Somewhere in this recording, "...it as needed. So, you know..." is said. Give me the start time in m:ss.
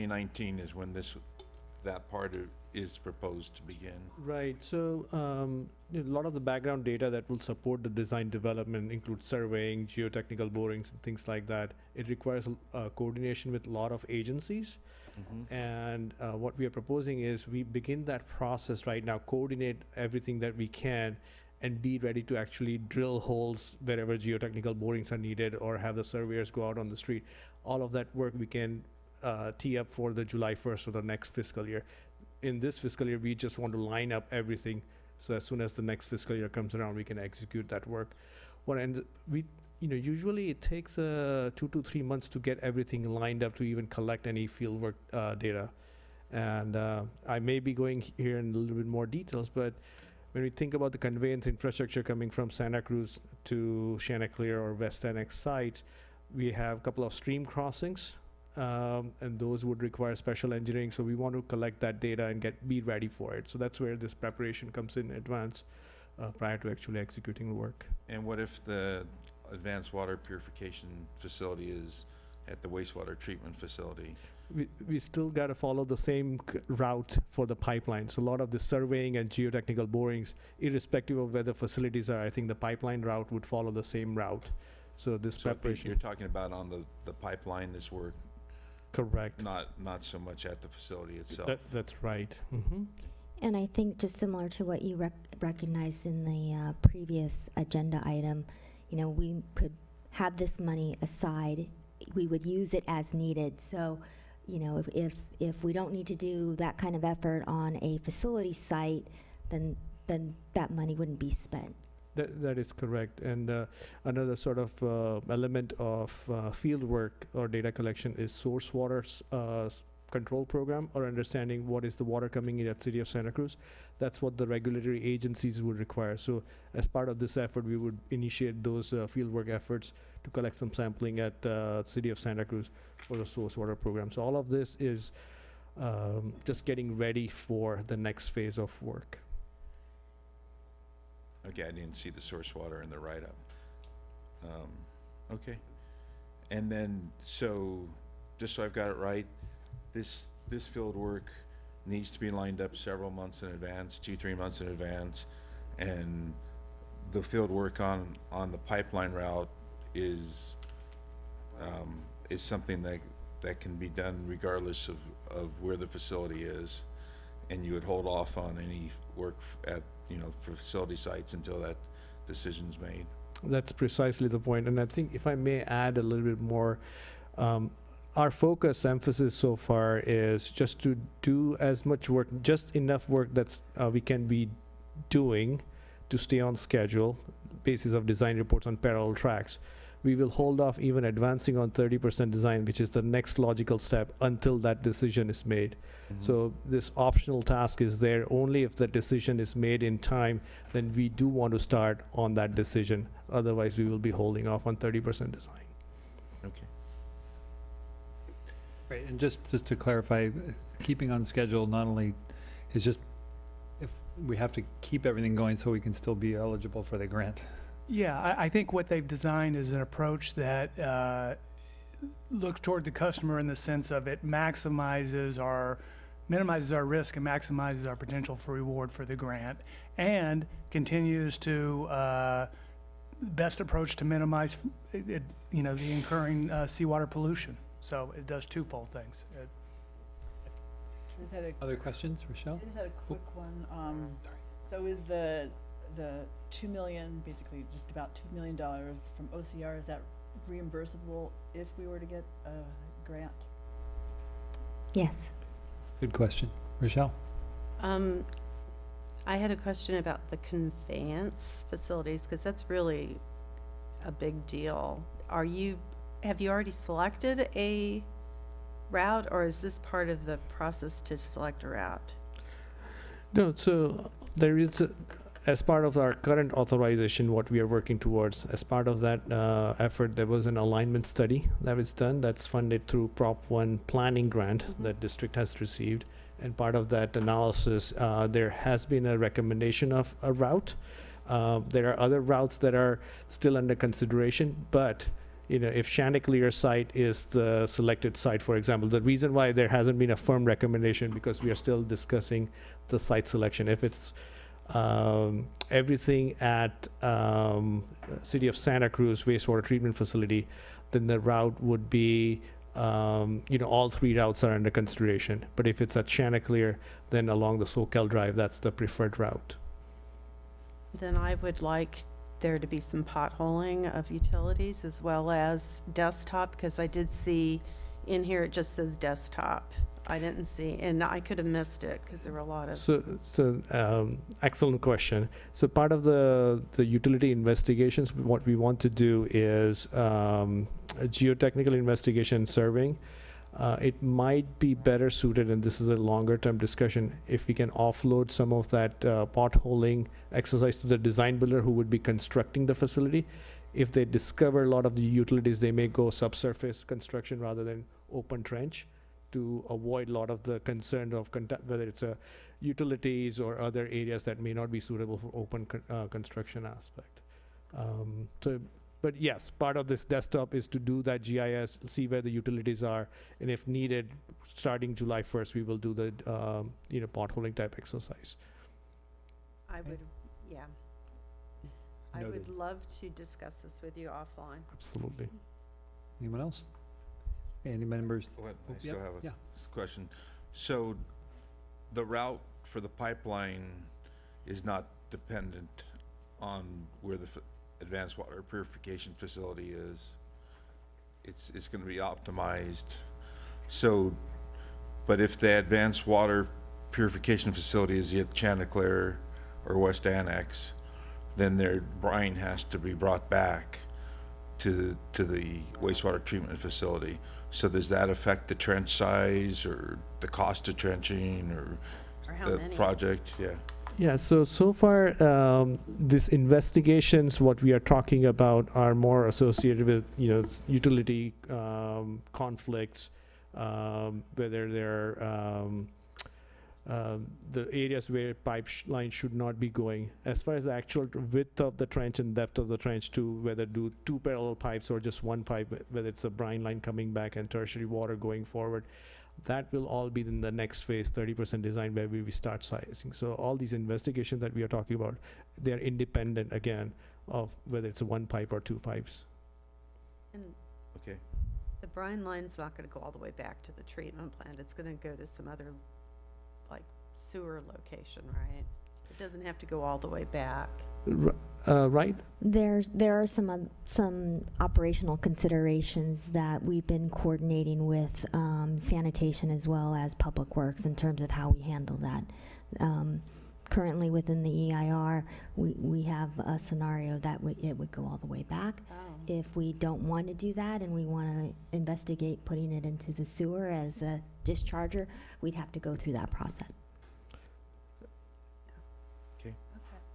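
1:42.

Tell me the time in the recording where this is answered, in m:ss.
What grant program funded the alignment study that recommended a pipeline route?
4:43.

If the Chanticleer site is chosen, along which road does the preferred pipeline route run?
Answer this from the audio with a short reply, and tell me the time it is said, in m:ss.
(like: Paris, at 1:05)
Soquel Drive, at 5:17.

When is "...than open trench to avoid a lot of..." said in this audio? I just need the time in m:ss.
5:57.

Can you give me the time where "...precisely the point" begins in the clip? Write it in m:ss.
2:53.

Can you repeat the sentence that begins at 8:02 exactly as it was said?
Um, Currently, within the EIR, we, we have a scenario that it would go all the way back.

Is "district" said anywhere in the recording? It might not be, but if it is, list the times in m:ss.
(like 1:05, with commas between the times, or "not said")
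4:45.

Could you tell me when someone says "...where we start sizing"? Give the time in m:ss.
7:31.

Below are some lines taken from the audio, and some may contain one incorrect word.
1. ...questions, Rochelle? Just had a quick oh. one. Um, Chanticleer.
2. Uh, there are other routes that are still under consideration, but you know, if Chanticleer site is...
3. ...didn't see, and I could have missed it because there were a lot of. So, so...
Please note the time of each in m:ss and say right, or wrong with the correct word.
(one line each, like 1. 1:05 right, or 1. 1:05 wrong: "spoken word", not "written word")
1. 4:01 wrong: "Sorry", not "Chanticleer"
2. 4:51 right
3. 5:30 right.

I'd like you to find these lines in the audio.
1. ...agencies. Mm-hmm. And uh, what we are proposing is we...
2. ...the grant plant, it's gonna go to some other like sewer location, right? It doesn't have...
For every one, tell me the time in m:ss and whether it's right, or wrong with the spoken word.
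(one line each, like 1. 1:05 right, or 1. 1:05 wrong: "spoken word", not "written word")
1. 0:14 right
2. 7:43 wrong: "treatment", not "grant".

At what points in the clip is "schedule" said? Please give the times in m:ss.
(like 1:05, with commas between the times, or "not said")
3:06, 3:31.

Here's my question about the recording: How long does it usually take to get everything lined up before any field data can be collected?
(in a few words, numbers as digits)
2 to 3 months.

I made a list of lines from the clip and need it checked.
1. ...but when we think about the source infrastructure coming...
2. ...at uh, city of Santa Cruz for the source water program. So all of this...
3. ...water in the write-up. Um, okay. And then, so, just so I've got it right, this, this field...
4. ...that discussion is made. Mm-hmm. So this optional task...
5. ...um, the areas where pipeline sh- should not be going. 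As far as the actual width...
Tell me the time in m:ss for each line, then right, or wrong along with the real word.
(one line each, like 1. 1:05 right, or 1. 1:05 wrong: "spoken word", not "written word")
1. 0:49 wrong: "conveyance", not "source"
2. 2:11 right
3. 2:22 right
4. 3:14 wrong: "decision", not "discussion"
5. 7:16 right.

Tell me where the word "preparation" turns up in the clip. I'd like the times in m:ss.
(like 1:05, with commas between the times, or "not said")
1:04, 1:25.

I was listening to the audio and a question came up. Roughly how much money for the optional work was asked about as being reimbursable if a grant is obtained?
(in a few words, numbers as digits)
about 2 million dollars.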